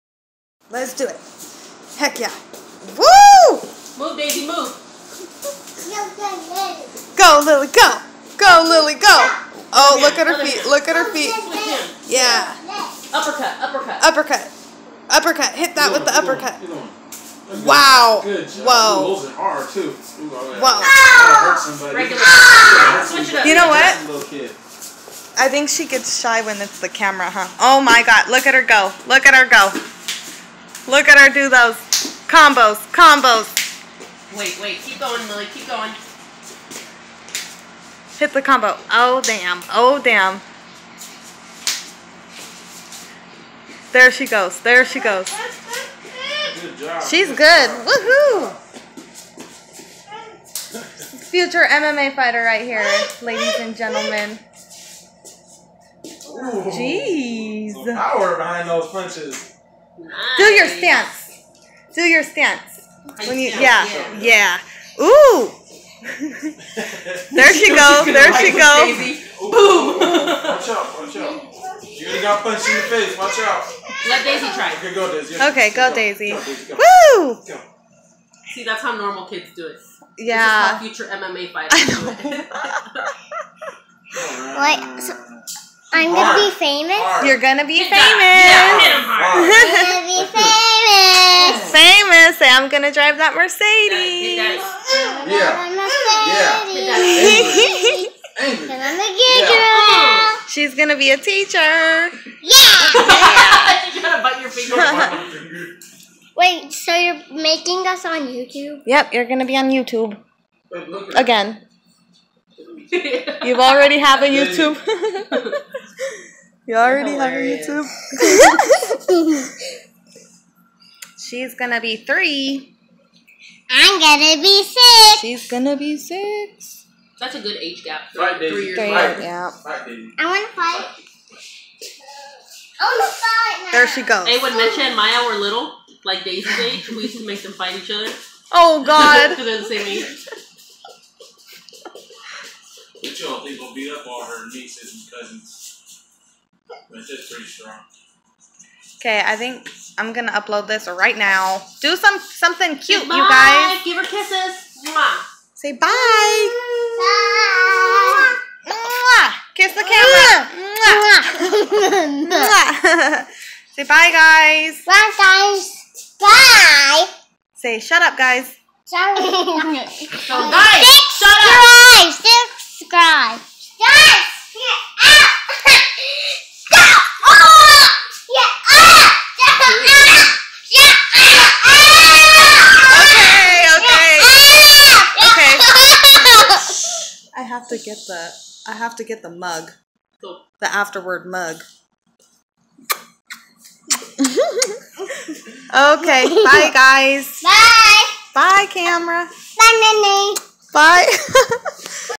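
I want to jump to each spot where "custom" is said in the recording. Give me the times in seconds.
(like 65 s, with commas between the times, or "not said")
not said.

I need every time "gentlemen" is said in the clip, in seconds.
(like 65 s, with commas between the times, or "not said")
53 s.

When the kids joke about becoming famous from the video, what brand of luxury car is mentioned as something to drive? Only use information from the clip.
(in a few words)
Mercedes.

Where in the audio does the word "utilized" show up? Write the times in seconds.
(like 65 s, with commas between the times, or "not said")
not said.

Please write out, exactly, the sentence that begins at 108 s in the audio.
Yep, you're gonna be on YouTube again.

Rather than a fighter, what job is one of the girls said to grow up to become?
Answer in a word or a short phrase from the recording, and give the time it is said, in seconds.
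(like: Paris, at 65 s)
Teacher, at 101 s.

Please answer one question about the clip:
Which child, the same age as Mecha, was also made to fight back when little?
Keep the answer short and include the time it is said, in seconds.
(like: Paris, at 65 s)
Maya, at 134 s.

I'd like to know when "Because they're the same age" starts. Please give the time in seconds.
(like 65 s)
139 s.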